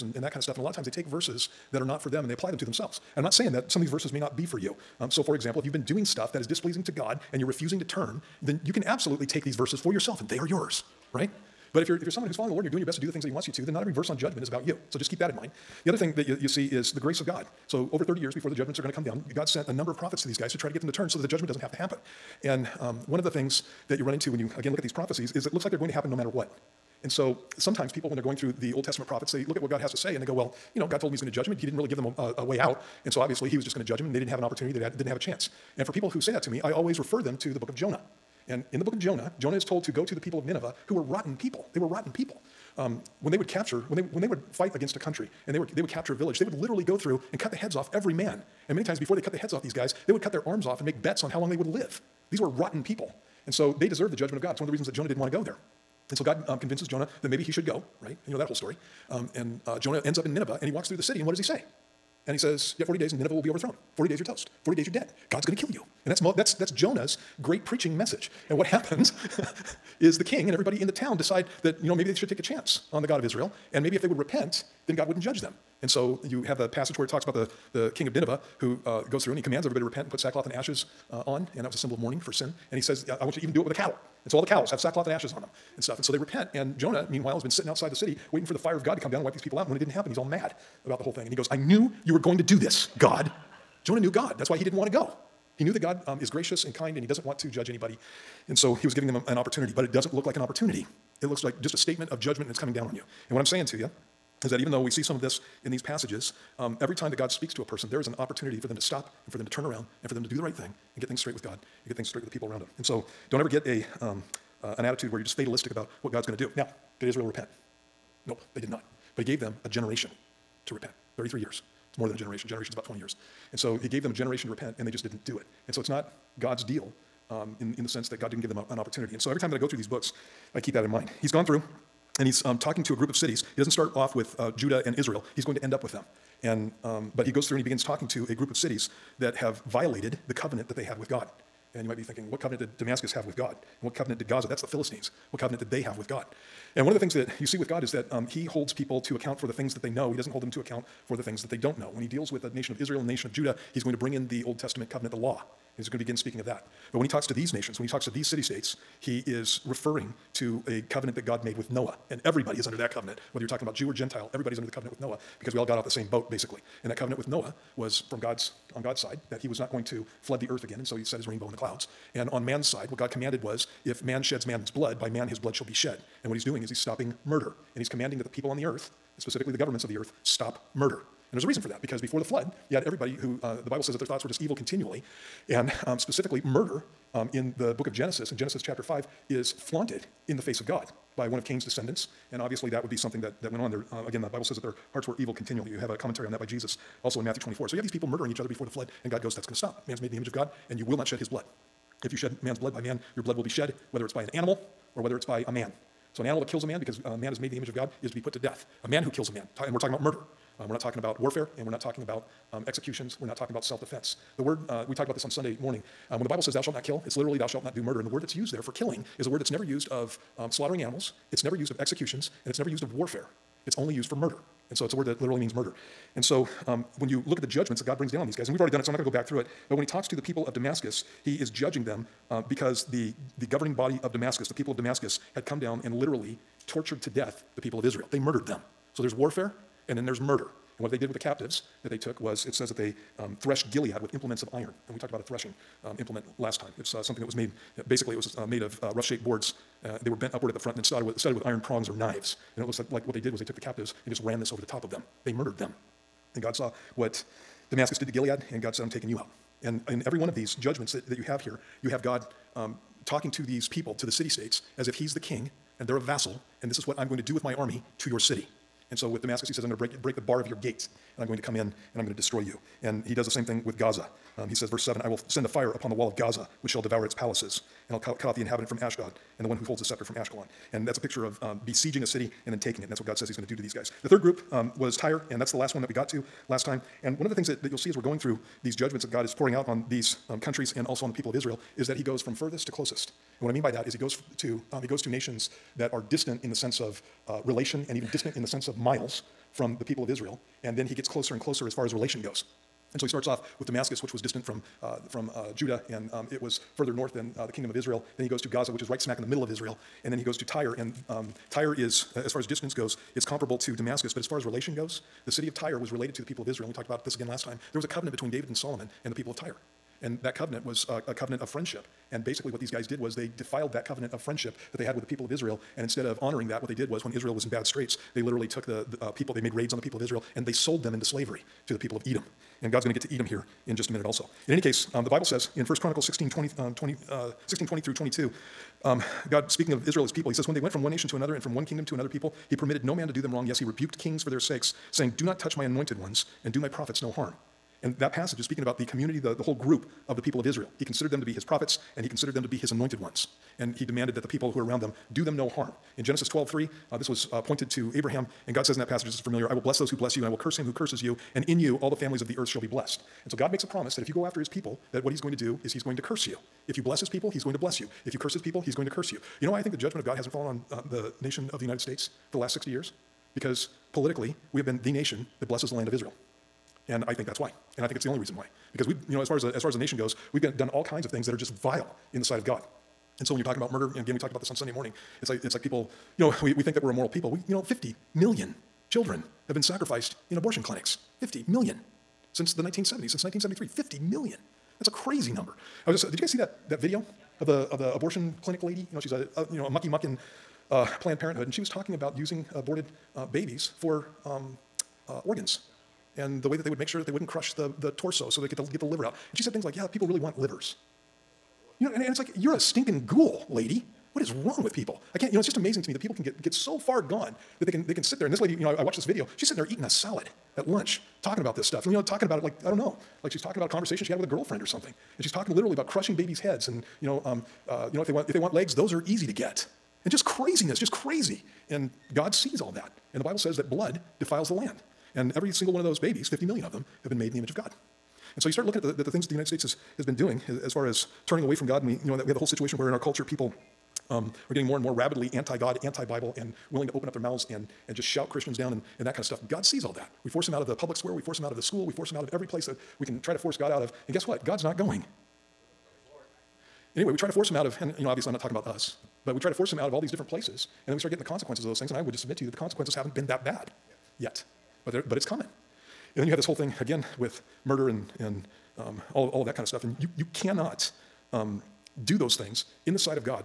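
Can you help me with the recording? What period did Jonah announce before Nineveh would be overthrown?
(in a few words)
40 days.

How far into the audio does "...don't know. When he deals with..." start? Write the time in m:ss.
2:31.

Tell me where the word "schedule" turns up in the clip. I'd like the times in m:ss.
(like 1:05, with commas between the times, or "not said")
not said.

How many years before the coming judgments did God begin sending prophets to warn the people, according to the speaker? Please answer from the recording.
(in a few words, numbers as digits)
over 30 years.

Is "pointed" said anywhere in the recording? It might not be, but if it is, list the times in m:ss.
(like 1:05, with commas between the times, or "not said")
5:57.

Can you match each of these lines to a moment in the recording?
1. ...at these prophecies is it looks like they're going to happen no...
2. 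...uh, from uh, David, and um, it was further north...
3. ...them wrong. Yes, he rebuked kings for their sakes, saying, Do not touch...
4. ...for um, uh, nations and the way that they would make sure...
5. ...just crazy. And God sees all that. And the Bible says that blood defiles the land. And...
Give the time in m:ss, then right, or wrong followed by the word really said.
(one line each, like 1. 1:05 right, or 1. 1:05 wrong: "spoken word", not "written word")
1. 0:24 right
2. 5:04 wrong: "Judah", not "David"
3. 5:43 right
4. 6:43 wrong: "organs", not "nations"
5. 7:10 right.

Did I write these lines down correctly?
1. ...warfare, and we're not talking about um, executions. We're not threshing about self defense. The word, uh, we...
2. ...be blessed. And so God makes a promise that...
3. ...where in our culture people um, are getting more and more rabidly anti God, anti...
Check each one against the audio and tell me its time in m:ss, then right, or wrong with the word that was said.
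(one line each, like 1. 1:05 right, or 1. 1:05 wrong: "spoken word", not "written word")
1. 3:31 wrong: "talking", not "threshing"
2. 6:02 right
3. 7:22 right.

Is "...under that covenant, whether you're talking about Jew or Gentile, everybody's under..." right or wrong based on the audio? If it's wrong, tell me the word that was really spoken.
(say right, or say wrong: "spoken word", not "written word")
right.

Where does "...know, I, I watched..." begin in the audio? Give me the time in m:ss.
6:58.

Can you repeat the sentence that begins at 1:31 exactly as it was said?
And he goes, I knew you were going to do this, God.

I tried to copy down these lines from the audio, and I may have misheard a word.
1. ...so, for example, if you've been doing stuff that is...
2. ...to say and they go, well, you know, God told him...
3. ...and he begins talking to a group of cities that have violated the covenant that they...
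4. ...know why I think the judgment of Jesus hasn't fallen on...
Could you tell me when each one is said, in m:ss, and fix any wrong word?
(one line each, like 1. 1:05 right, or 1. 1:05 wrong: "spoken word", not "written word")
1. 0:05 right
2. 0:29 right
3. 2:17 right
4. 6:09 wrong: "God", not "Jesus".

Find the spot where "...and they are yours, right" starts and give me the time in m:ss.
0:10.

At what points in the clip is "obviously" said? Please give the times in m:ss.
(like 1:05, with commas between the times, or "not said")
0:33, 3:12, 7:38.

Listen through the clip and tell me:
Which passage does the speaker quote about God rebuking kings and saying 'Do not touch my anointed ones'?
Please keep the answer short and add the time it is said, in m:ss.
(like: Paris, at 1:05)
1 Chronicles 16:20-22, at 5:35.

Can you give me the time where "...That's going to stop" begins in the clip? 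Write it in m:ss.
3:19.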